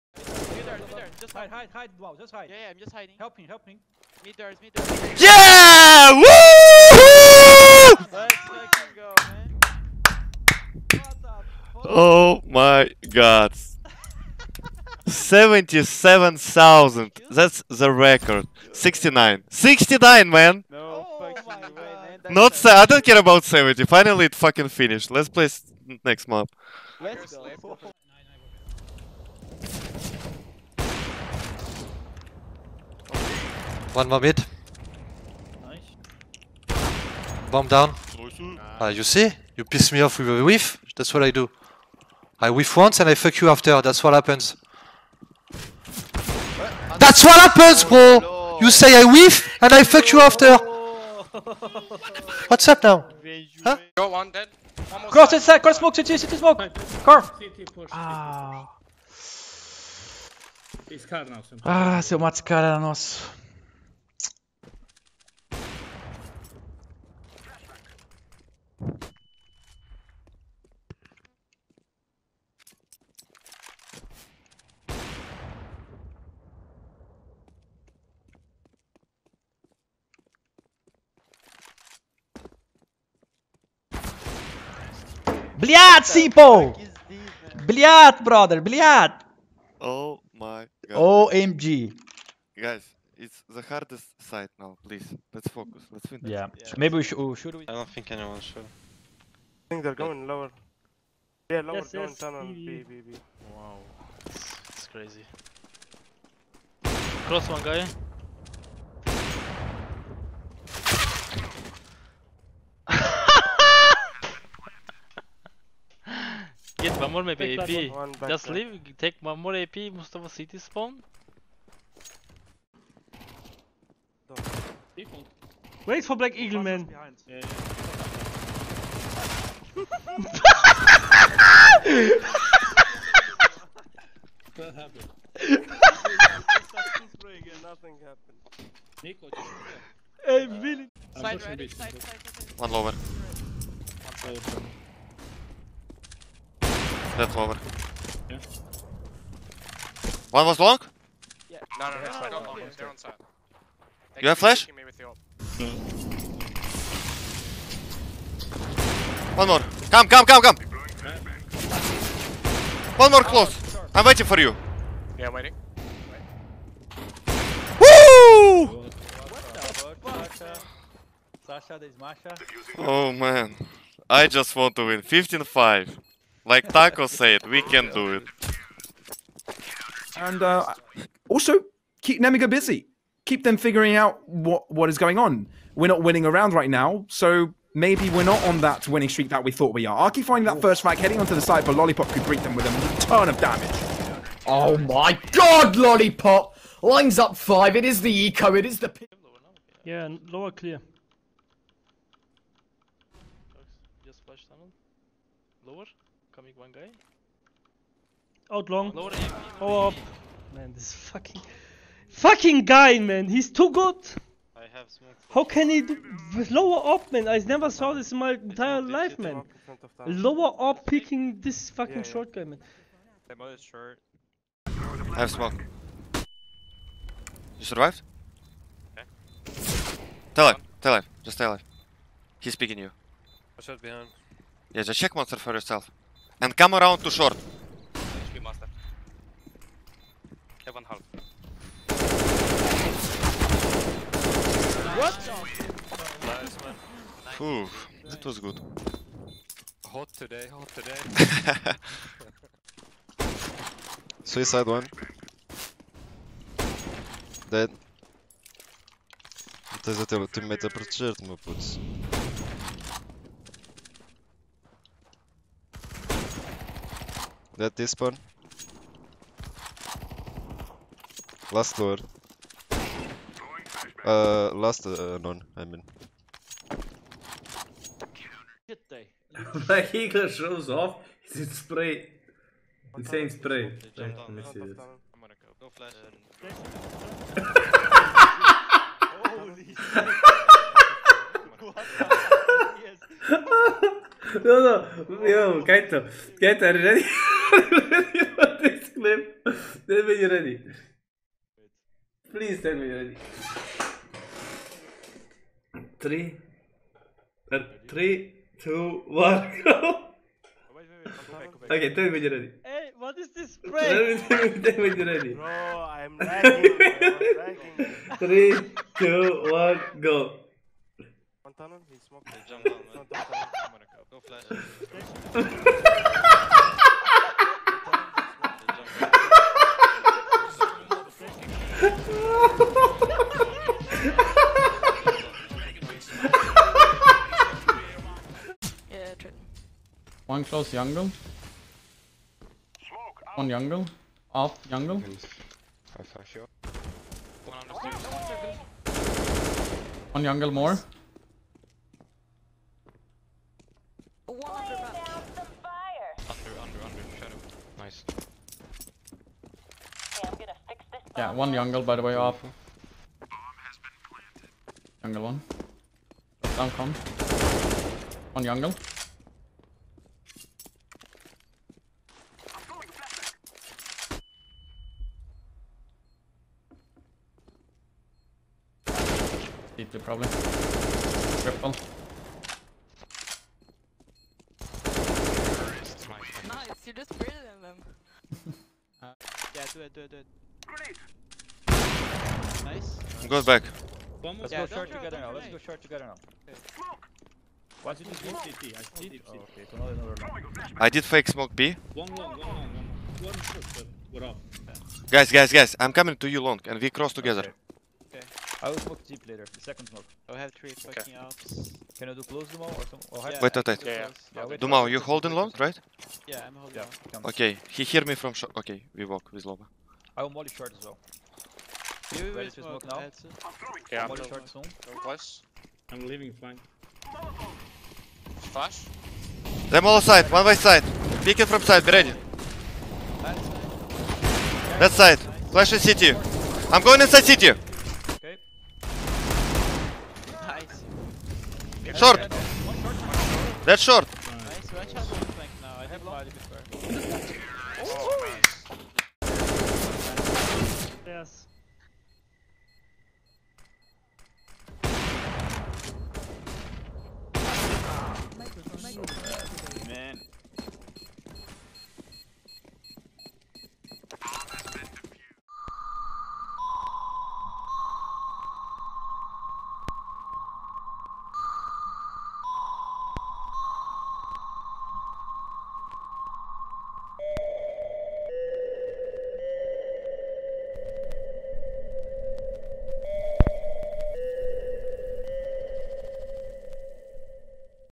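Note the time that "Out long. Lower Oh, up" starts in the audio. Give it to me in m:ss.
3:28.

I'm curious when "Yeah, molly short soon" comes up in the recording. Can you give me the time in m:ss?
7:03.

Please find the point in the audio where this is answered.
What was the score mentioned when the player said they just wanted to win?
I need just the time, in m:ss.
2:55.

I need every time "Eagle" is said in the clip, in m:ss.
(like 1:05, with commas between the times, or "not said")
2:06, 4:39.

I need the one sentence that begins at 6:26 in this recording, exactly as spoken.
Nice, you just breathe in them.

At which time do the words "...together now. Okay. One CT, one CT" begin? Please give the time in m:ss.
6:35.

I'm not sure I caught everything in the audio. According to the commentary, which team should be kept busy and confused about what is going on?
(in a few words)
Nemiga.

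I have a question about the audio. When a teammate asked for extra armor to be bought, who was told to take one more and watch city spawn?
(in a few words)
Mustafa.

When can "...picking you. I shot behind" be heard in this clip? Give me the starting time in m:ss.
3:52.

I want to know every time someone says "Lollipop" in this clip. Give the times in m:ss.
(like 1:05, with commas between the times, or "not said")
3:11, 3:15.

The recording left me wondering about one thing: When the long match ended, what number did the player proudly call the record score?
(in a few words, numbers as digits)
77,000.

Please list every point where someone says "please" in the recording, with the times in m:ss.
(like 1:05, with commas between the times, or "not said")
1:34, 5:02.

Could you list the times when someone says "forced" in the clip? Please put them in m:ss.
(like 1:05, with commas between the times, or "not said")
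not said.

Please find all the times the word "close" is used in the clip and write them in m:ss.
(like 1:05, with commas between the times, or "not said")
2:43, 5:40, 6:52.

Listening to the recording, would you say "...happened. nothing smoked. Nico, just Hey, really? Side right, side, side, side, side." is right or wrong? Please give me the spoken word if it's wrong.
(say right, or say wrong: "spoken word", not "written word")
wrong: "happened", not "smoked".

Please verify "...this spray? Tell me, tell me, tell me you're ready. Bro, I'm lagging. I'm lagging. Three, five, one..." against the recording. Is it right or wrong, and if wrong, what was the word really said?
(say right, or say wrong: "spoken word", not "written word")
wrong: "two", not "five".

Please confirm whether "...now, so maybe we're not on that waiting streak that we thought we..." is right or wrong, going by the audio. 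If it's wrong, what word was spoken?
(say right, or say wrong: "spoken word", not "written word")
wrong: "winning", not "waiting".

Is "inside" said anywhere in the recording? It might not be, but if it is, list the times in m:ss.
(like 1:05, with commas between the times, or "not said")
0:55, 7:17.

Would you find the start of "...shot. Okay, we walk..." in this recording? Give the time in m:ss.
6:58.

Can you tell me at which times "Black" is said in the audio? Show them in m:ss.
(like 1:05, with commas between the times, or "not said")
2:06, 4:39.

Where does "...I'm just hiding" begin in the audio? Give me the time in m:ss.
0:02.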